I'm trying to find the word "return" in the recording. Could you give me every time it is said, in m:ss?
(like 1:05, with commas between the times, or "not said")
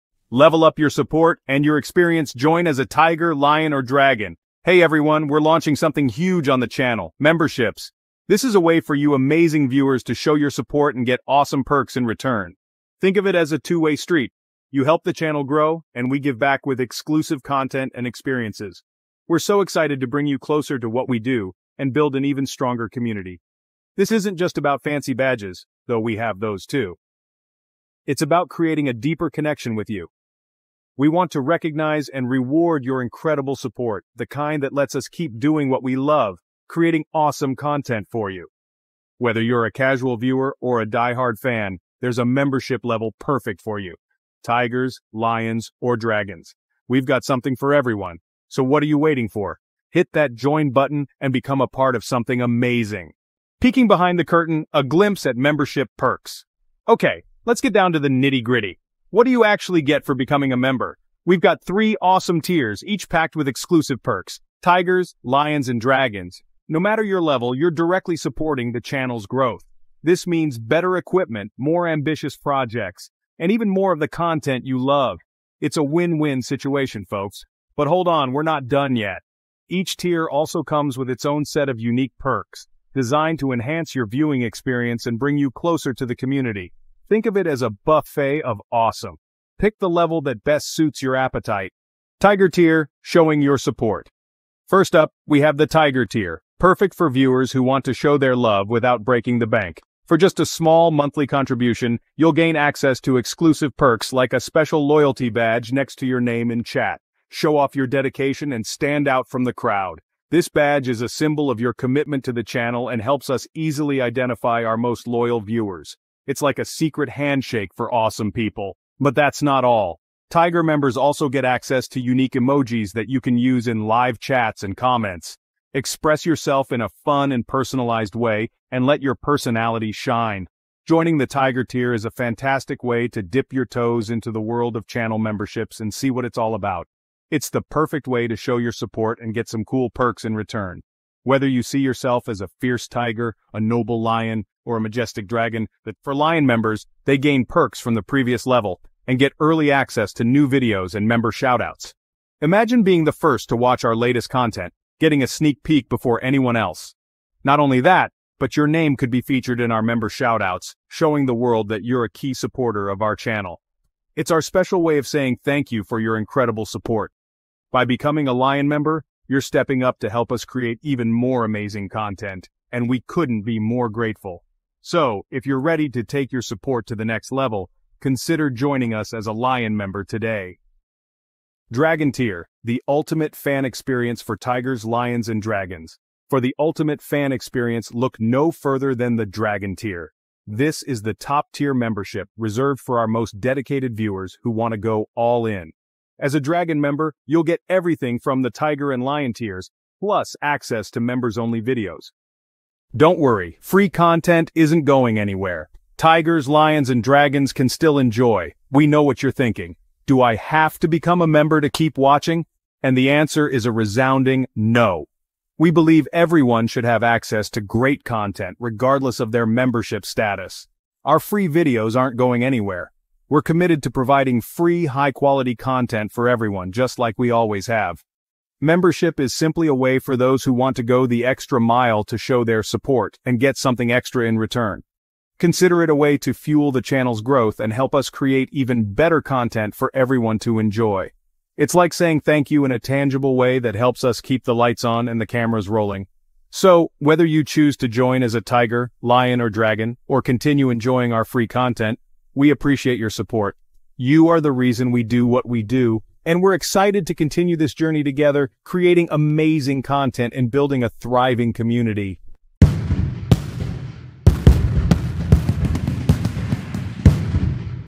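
0:12, 2:20, 3:54.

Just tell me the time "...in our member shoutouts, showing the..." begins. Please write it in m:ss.
2:39.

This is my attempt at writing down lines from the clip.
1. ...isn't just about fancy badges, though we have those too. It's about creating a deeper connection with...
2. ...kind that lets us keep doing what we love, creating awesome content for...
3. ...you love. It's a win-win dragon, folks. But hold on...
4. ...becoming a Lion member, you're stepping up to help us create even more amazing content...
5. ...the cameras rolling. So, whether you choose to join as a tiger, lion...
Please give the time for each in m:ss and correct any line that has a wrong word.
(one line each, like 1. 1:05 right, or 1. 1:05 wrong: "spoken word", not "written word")
1. 0:24 right
2. 0:34 right
3. 1:14 wrong: "situation", not "dragon"
4. 2:47 right
5. 4:05 right.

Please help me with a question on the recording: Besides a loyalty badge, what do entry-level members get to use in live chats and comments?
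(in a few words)
Unique emojis.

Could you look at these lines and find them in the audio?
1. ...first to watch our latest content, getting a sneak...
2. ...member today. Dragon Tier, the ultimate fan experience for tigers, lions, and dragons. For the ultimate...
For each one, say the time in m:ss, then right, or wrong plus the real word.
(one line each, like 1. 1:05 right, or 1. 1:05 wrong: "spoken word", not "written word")
1. 2:33 right
2. 2:59 right.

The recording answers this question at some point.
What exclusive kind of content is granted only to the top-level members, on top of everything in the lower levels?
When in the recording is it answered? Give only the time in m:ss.
3:20.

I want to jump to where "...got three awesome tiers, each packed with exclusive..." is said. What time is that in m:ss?
1:01.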